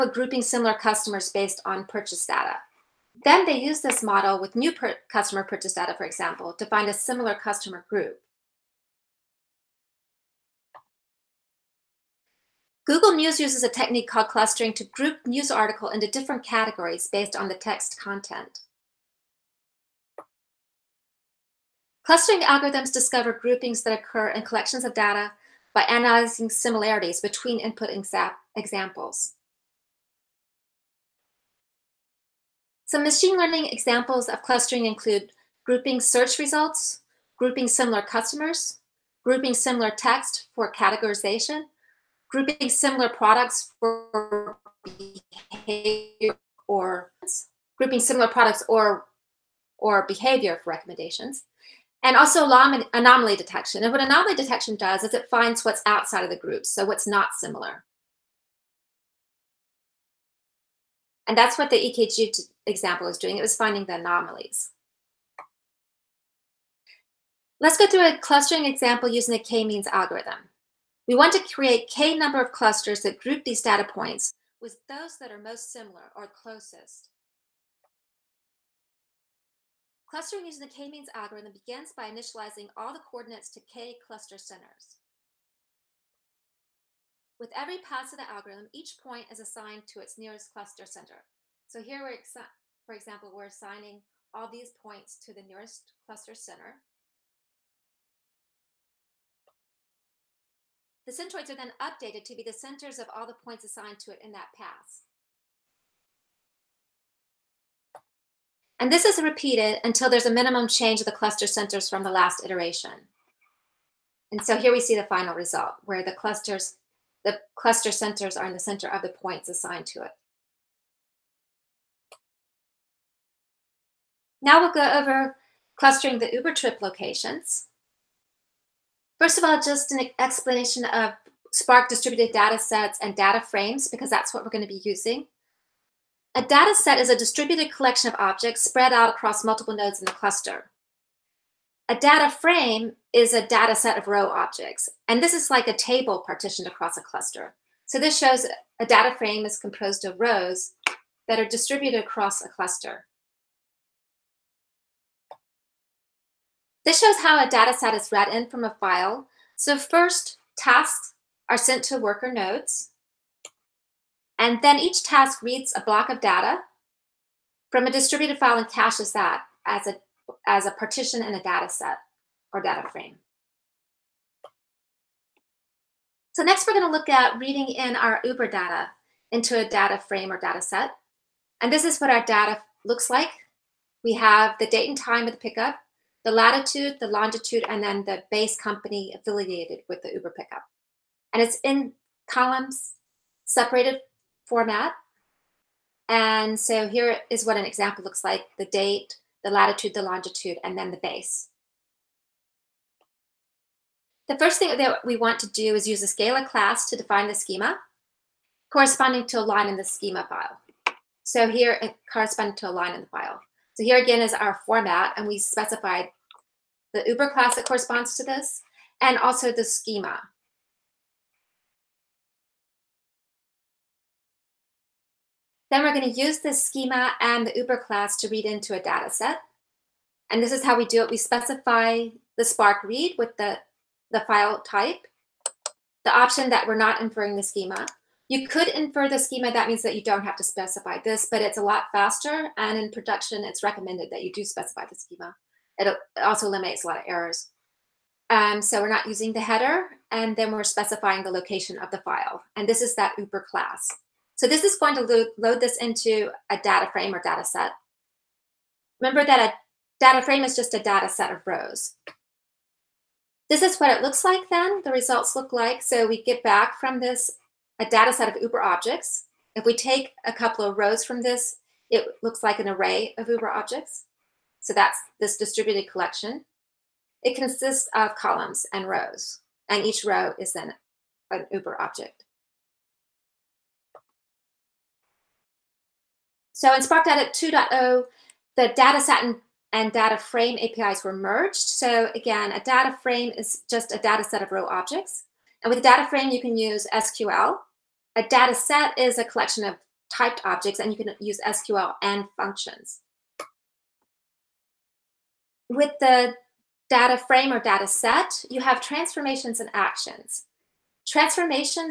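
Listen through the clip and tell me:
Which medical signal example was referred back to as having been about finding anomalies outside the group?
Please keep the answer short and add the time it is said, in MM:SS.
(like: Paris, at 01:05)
EKG, at 01:01.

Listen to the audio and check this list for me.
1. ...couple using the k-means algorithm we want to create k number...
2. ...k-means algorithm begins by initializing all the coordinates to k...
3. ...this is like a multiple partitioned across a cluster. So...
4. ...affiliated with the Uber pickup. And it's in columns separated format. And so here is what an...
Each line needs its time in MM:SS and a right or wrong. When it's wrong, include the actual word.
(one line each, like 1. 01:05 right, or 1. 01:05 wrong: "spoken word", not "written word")
1. 01:08 wrong: "example", not "couple"
2. 01:20 right
3. 02:25 wrong: "table", not "multiple"
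4. 03:09 right.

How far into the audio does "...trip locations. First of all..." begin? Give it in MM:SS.
02:06.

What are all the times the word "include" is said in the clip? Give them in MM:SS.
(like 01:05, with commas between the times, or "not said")
00:34.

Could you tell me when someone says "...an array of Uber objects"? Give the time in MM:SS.
04:32.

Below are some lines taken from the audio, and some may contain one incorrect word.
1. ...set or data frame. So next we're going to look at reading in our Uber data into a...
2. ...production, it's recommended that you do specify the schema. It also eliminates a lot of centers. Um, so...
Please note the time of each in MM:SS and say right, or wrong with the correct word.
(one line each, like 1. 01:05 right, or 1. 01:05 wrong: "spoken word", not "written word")
1. 02:51 right
2. 04:02 wrong: "errors", not "centers".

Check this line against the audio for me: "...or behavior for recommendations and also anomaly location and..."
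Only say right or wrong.
wrong.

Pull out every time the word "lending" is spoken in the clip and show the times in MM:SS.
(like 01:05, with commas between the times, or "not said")
not said.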